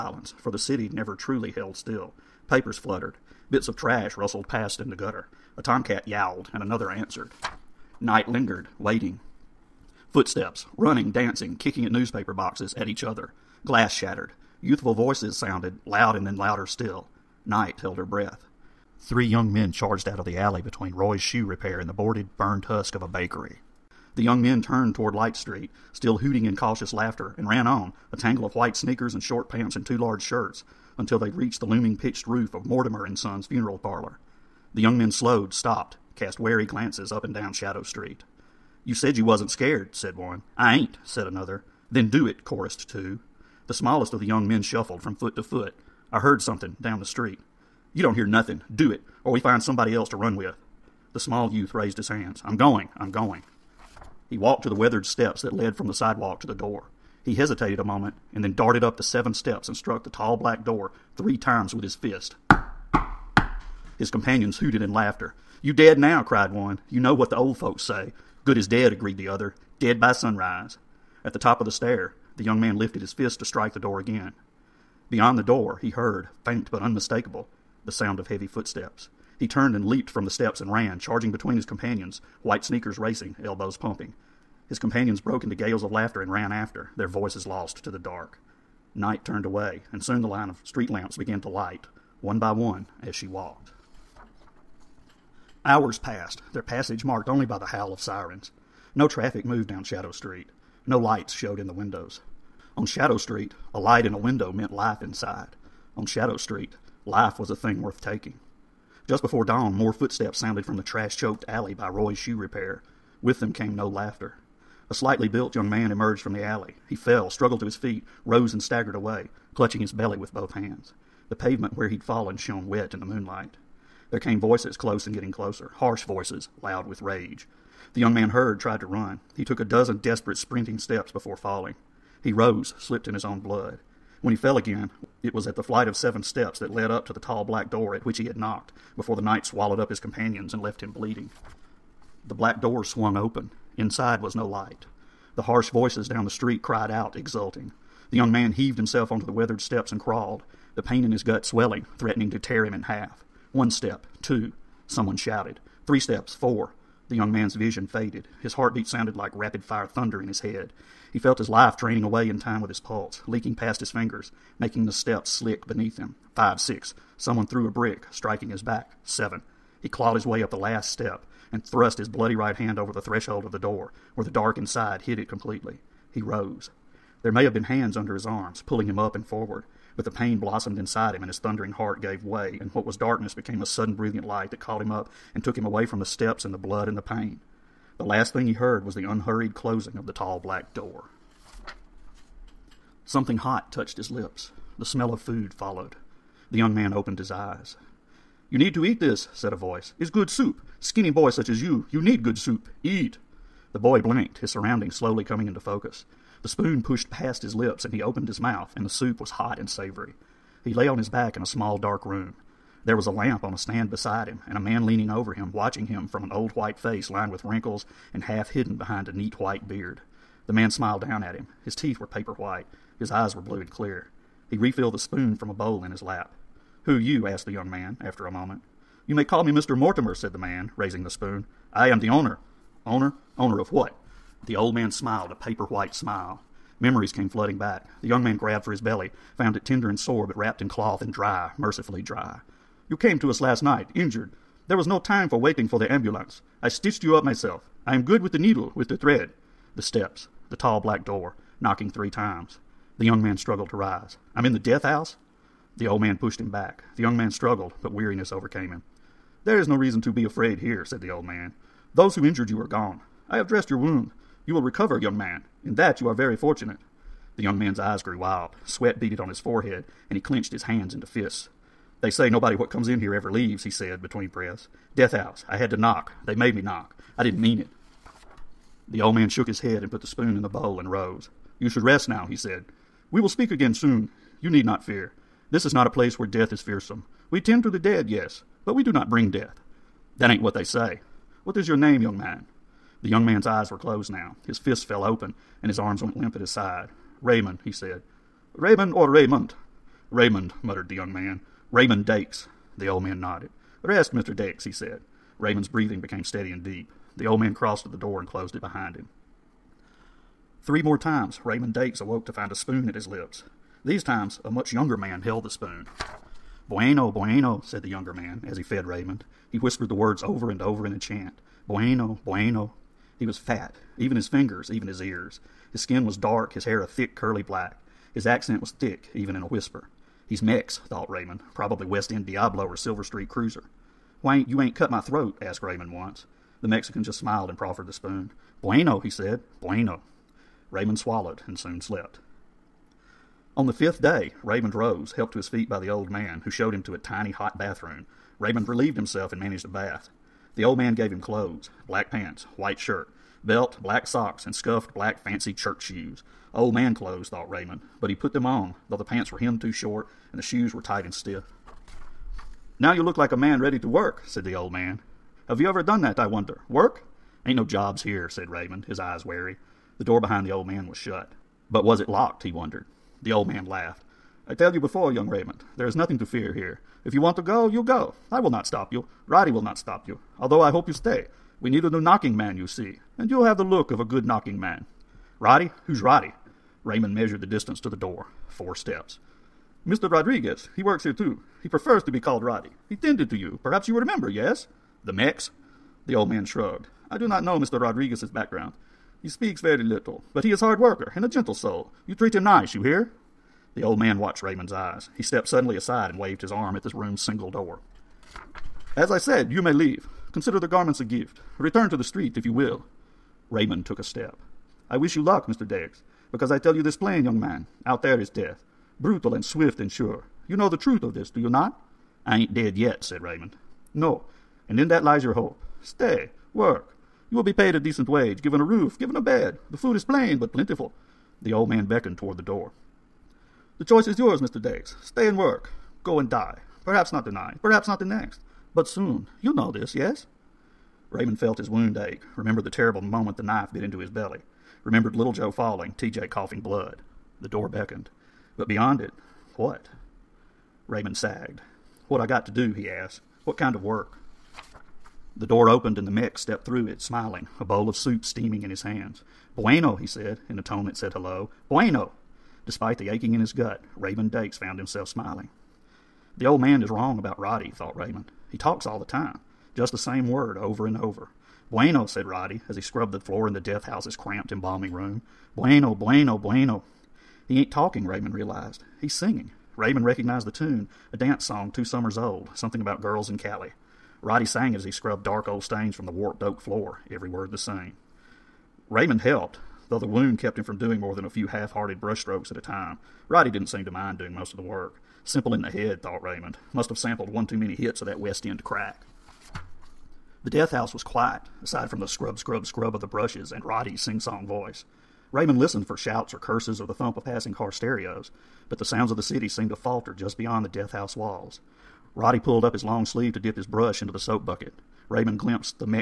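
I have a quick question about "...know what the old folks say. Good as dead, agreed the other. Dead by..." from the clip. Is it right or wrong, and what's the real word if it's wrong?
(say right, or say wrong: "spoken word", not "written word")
right.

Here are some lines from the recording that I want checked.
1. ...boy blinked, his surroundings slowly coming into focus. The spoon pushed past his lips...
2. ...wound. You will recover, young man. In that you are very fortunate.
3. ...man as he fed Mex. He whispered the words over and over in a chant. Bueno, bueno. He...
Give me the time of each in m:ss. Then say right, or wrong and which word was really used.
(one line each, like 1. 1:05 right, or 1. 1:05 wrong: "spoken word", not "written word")
1. 3:23 right
2. 4:23 right
3. 5:18 wrong: "Raymond", not "Mex".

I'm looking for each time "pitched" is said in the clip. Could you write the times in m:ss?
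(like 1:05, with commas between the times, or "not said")
0:31.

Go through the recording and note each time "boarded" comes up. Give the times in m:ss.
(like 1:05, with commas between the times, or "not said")
0:21.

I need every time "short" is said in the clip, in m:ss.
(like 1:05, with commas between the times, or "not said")
0:29, 5:59.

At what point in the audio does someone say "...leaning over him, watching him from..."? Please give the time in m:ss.
3:34.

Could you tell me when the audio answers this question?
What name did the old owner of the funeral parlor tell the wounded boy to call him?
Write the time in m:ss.
3:49.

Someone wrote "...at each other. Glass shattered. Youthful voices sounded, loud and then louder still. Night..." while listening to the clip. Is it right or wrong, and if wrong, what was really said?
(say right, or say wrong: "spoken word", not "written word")
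right.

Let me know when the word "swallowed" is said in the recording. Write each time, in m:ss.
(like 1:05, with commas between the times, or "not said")
2:19, 5:40.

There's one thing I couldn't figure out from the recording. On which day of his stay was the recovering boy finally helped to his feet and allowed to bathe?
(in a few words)
fifth day.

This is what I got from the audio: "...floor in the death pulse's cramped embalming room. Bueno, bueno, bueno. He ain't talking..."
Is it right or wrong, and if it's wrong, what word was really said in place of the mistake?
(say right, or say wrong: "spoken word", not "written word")
wrong: "house", not "pulse".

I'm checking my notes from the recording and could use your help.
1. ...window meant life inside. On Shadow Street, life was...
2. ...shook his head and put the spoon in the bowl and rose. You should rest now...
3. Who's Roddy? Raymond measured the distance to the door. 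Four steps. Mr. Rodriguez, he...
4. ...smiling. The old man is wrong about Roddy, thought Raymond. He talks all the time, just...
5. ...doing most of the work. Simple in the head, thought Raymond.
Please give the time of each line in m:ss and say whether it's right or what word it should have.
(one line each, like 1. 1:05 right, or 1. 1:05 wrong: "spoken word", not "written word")
1. 1:44 right
2. 4:39 right
3. 6:25 right
4. 7:45 right
5. 8:14 right.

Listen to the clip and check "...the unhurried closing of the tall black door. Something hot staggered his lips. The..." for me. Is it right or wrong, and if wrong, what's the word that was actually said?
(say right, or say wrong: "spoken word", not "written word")
wrong: "touched", not "staggered".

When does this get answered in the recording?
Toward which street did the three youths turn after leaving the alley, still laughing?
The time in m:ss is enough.
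0:25.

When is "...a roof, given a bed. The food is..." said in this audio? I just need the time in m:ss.
7:08.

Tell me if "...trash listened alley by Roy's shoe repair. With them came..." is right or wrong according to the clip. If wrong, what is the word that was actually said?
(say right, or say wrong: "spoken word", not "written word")
wrong: "choked", not "listened".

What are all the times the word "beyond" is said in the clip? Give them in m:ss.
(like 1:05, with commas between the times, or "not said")
1:15, 7:28, 8:30.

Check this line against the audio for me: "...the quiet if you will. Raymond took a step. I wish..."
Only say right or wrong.
wrong.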